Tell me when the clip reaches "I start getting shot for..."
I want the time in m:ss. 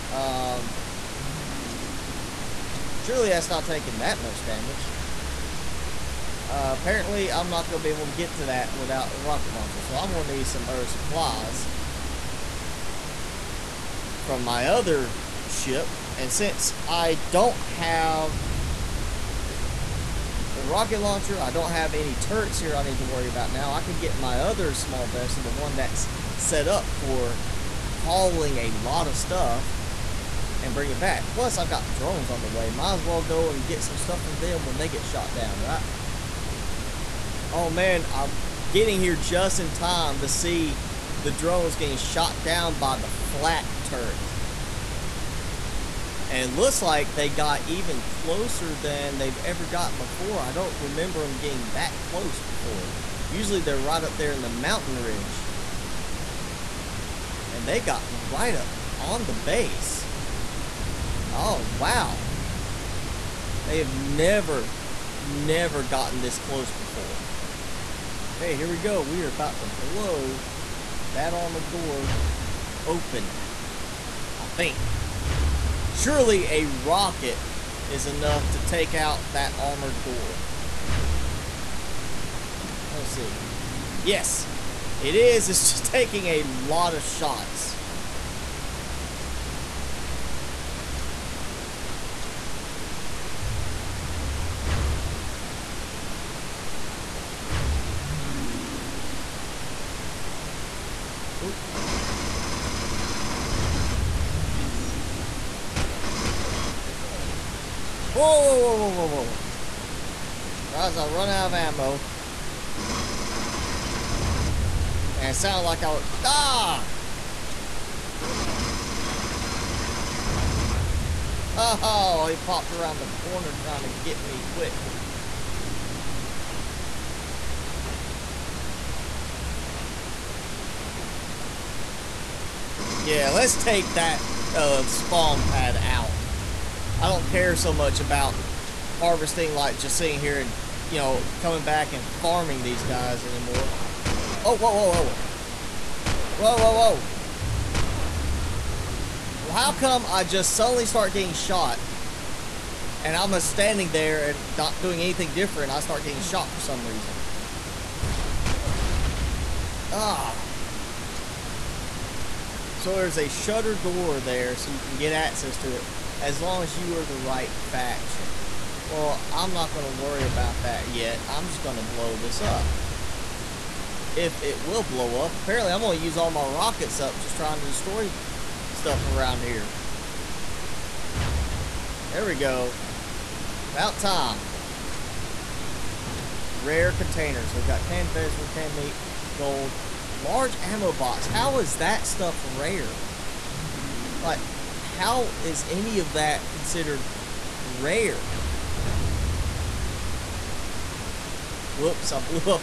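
2:35.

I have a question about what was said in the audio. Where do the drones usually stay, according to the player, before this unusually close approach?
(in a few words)
mountain ridge.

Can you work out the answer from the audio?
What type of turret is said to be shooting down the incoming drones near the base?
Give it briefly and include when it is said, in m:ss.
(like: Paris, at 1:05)
flak turret, at 0:43.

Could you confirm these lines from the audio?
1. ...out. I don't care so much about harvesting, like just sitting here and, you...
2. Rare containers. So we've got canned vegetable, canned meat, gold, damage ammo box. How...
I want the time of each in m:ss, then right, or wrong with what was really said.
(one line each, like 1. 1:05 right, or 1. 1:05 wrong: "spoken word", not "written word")
1. 2:15 right
2. 3:06 wrong: "large", not "damage".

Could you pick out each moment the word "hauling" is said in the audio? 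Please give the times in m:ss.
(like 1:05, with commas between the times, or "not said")
0:27.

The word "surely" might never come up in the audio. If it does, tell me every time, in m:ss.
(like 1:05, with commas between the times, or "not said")
0:02, 1:15.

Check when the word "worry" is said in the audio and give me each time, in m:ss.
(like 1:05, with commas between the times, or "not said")
0:23, 2:49.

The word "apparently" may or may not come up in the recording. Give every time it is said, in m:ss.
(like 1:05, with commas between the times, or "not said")
0:06, 2:55.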